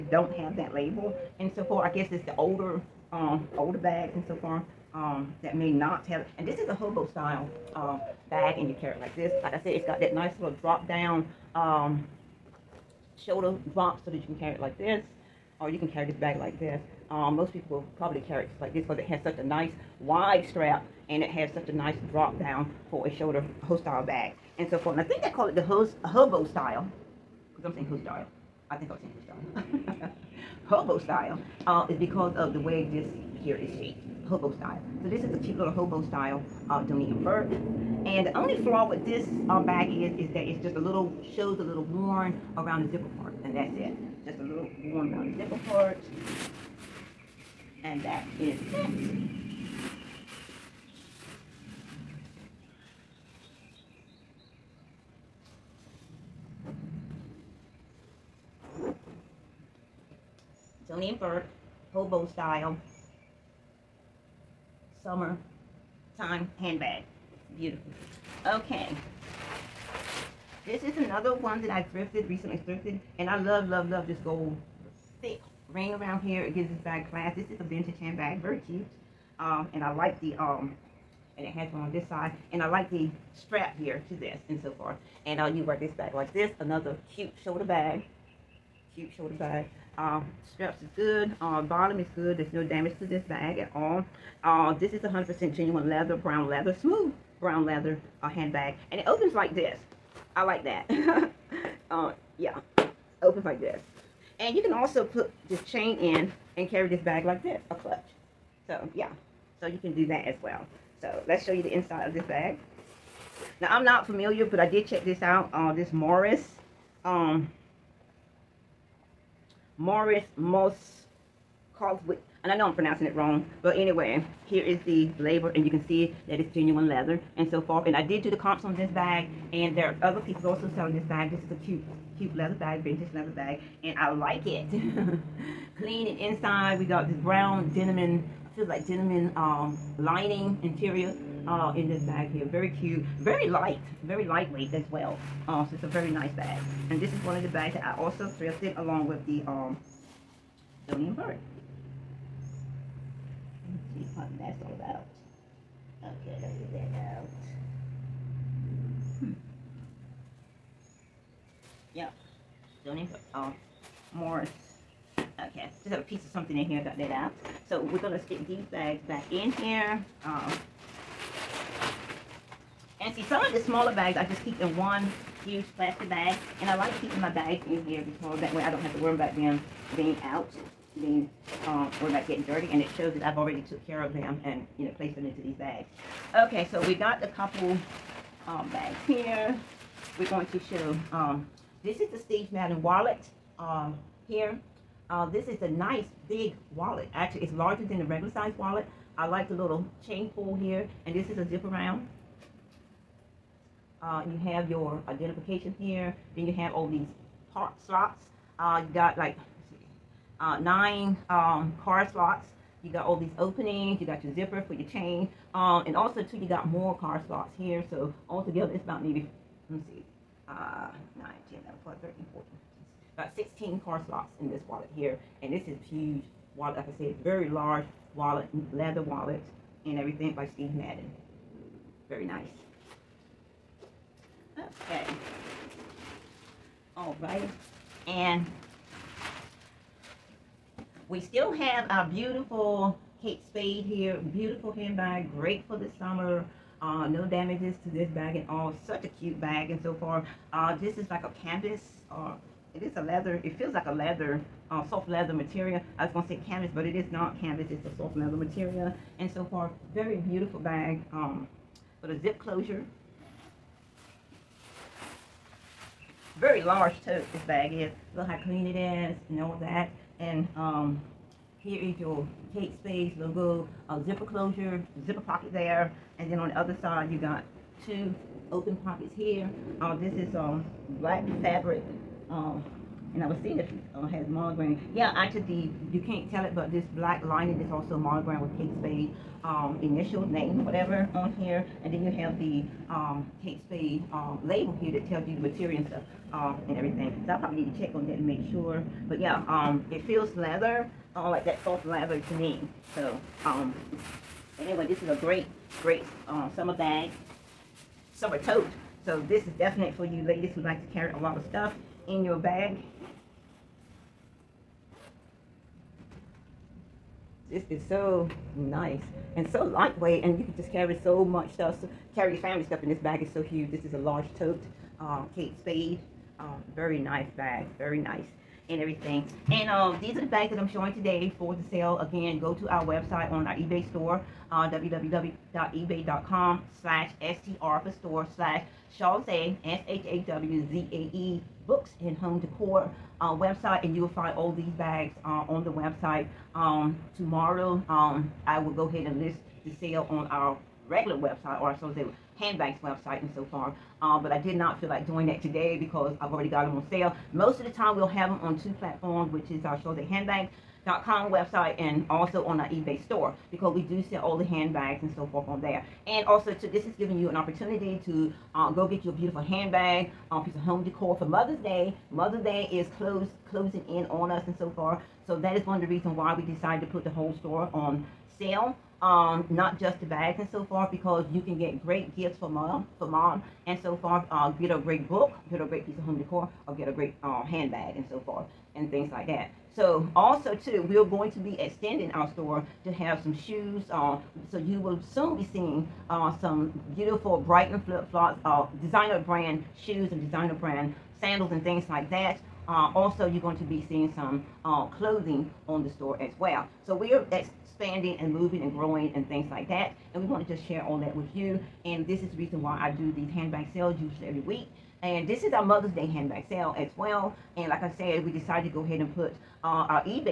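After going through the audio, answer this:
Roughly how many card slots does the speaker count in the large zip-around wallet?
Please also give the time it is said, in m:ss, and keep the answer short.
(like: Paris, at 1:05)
16, at 3:43.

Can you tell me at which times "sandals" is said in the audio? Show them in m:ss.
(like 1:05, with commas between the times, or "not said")
6:41.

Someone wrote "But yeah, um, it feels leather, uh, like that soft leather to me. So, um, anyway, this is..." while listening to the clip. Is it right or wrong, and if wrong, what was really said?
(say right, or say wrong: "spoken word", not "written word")
right.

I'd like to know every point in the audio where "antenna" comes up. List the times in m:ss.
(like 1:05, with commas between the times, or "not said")
not said.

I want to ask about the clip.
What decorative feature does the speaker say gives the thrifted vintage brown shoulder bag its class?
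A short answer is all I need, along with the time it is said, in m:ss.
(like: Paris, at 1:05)
gold thick ring, at 1:14.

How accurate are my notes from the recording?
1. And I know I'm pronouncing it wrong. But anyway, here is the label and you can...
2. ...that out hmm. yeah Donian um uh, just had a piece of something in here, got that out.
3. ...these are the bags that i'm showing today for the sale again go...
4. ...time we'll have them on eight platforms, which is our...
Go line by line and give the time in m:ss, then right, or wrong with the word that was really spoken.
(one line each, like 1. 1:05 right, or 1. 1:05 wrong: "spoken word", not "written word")
1. 2:02 right
2. 2:36 right
3. 5:29 right
4. 5:57 wrong: "two", not "eight".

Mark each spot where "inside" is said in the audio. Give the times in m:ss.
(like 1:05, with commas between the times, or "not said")
1:51, 2:16.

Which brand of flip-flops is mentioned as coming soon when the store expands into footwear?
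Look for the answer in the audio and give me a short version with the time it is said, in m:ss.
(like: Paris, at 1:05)
Brighton, at 6:37.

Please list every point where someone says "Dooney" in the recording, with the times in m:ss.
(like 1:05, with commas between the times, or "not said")
0:36, 1:00, 2:30.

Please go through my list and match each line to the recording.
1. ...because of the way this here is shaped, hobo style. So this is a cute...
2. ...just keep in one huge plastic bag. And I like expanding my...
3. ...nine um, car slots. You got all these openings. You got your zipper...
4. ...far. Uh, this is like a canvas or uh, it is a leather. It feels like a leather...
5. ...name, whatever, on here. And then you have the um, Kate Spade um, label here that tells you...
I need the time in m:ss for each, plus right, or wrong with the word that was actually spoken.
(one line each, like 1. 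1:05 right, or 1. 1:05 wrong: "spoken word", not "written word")
1. 0:31 right
2. 2:54 wrong: "keeping", not "expanding"
3. 3:30 right
4. 4:10 right
5. 4:50 right.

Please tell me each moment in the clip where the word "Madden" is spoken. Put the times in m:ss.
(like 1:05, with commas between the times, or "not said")
3:12, 3:50.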